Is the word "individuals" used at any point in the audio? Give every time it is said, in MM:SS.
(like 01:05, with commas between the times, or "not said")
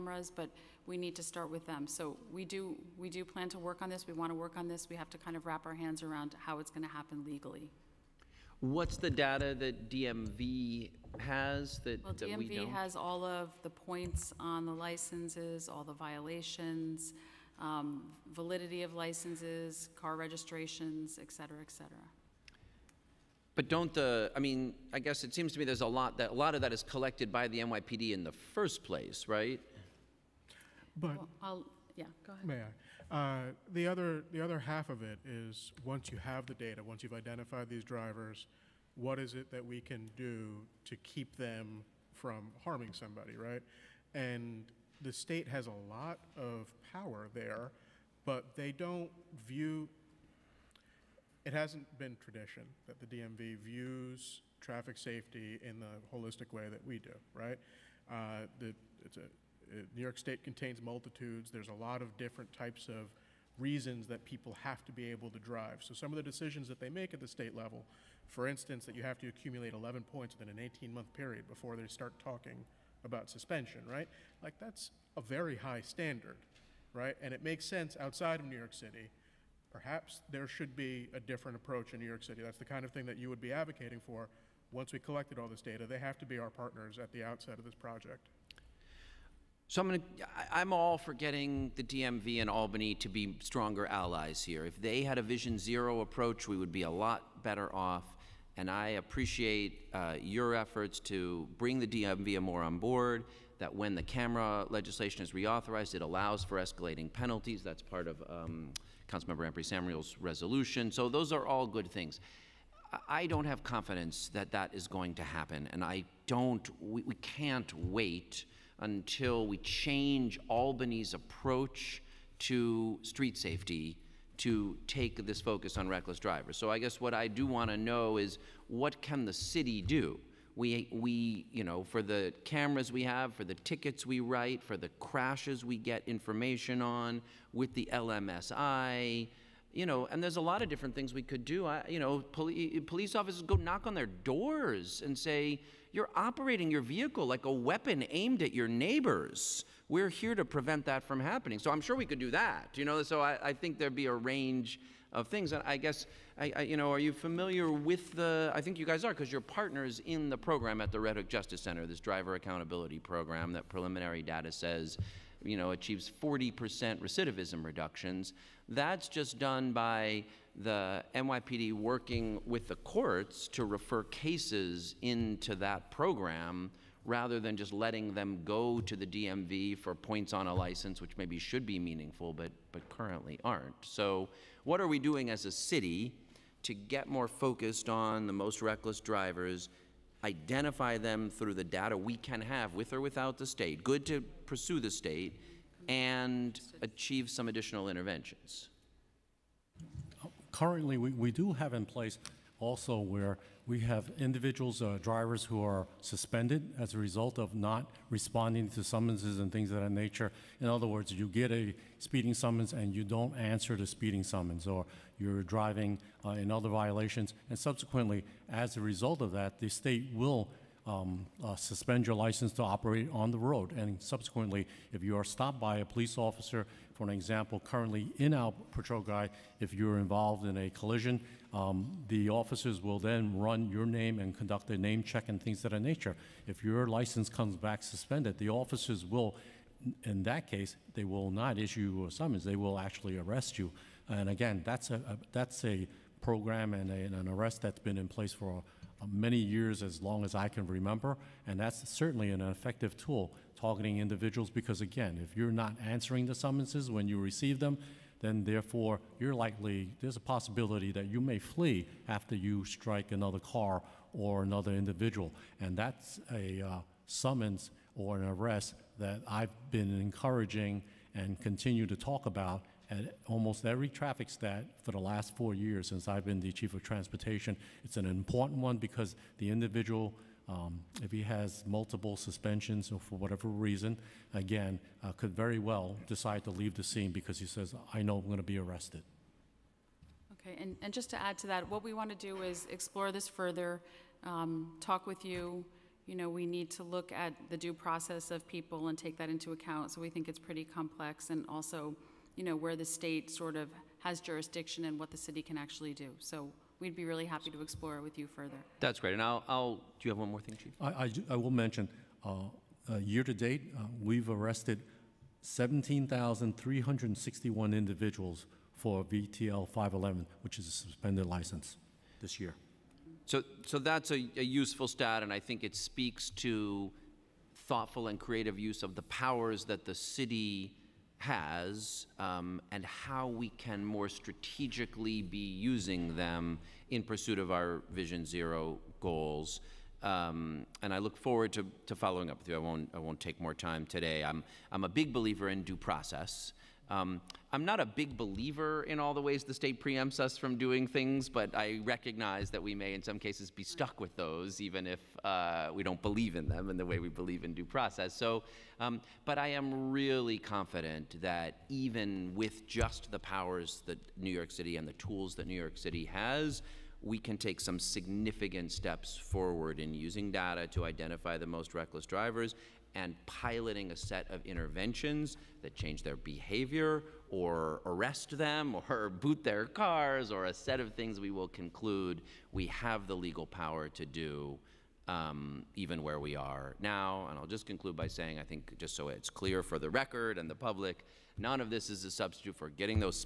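03:24, 04:13, 04:24, 04:39, 05:17.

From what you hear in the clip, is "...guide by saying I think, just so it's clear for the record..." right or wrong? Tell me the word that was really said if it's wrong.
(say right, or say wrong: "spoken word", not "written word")
wrong: "conclude", not "guide".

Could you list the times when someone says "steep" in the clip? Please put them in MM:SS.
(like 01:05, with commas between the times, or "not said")
not said.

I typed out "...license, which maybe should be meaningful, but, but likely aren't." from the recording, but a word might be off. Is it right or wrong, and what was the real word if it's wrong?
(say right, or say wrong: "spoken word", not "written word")
wrong: "currently", not "likely".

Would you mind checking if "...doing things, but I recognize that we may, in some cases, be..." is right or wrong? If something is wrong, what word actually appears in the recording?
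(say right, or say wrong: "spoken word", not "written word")
right.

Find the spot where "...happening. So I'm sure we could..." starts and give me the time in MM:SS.
02:31.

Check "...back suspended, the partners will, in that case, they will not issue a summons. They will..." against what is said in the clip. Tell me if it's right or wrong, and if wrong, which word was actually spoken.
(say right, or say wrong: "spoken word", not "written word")
wrong: "officers", not "partners".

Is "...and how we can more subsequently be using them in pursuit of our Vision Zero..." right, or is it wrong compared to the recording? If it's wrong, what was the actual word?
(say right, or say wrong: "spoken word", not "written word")
wrong: "strategically", not "subsequently".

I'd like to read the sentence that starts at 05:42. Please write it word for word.
I won't, I won't take more time today.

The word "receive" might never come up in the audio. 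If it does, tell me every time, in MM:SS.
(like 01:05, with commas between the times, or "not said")
04:17.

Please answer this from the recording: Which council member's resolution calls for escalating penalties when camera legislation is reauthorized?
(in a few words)
Ampry Samuel.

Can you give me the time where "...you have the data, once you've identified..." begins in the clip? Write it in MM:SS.
00:36.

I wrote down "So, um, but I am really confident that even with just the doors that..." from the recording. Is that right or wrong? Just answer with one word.
wrong.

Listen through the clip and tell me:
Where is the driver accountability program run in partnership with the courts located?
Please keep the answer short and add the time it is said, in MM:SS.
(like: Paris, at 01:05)
Red Hook Justice Center, at 02:40.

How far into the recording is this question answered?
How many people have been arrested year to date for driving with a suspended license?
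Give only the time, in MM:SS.
05:15.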